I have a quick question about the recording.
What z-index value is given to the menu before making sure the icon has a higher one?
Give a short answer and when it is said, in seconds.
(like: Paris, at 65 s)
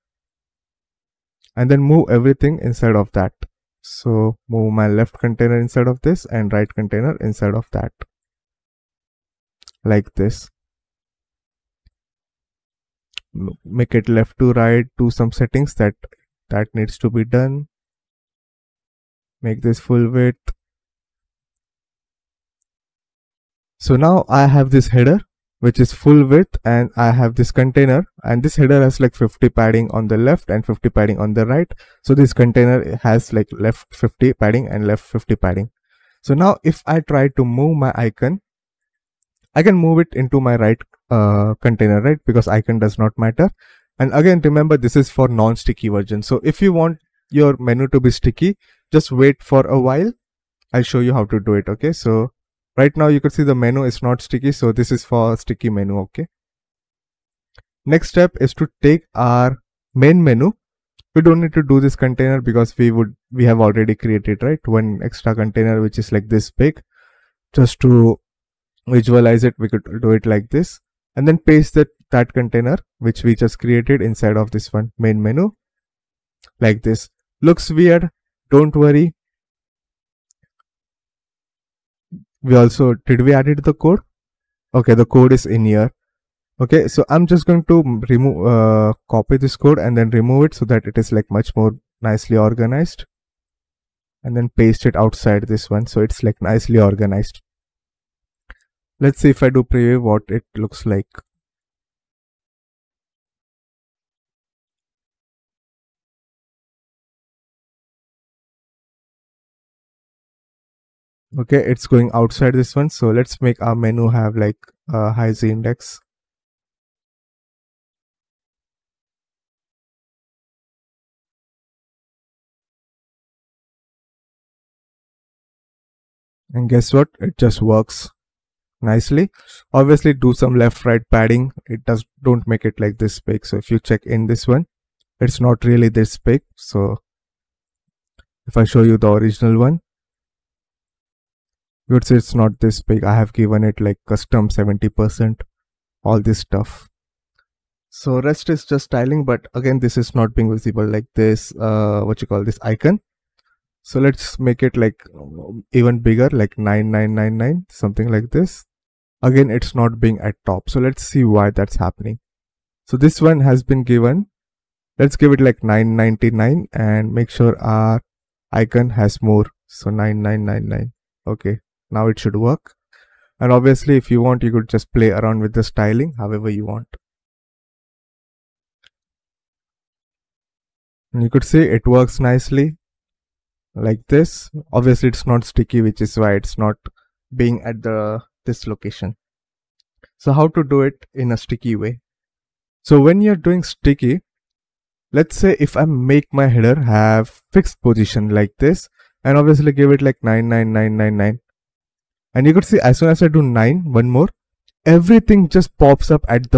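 999, at 165 s.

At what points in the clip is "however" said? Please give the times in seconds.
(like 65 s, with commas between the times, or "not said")
176 s.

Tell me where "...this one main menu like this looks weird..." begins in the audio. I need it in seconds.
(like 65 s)
74 s.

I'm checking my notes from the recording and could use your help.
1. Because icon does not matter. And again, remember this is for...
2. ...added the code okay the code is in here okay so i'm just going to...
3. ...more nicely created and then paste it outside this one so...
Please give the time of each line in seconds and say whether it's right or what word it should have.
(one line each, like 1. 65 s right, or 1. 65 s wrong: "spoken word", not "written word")
1. 42 s right
2. 83 s right
3. 91 s wrong: "organized", not "created".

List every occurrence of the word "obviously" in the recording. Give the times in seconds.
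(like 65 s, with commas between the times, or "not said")
129 s, 173 s, 184 s, 199 s.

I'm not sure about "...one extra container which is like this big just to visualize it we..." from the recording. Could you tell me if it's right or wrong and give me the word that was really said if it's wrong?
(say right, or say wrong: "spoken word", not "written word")
right.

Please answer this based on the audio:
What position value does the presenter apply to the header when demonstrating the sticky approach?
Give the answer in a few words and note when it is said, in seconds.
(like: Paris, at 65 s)
fixed, at 197 s.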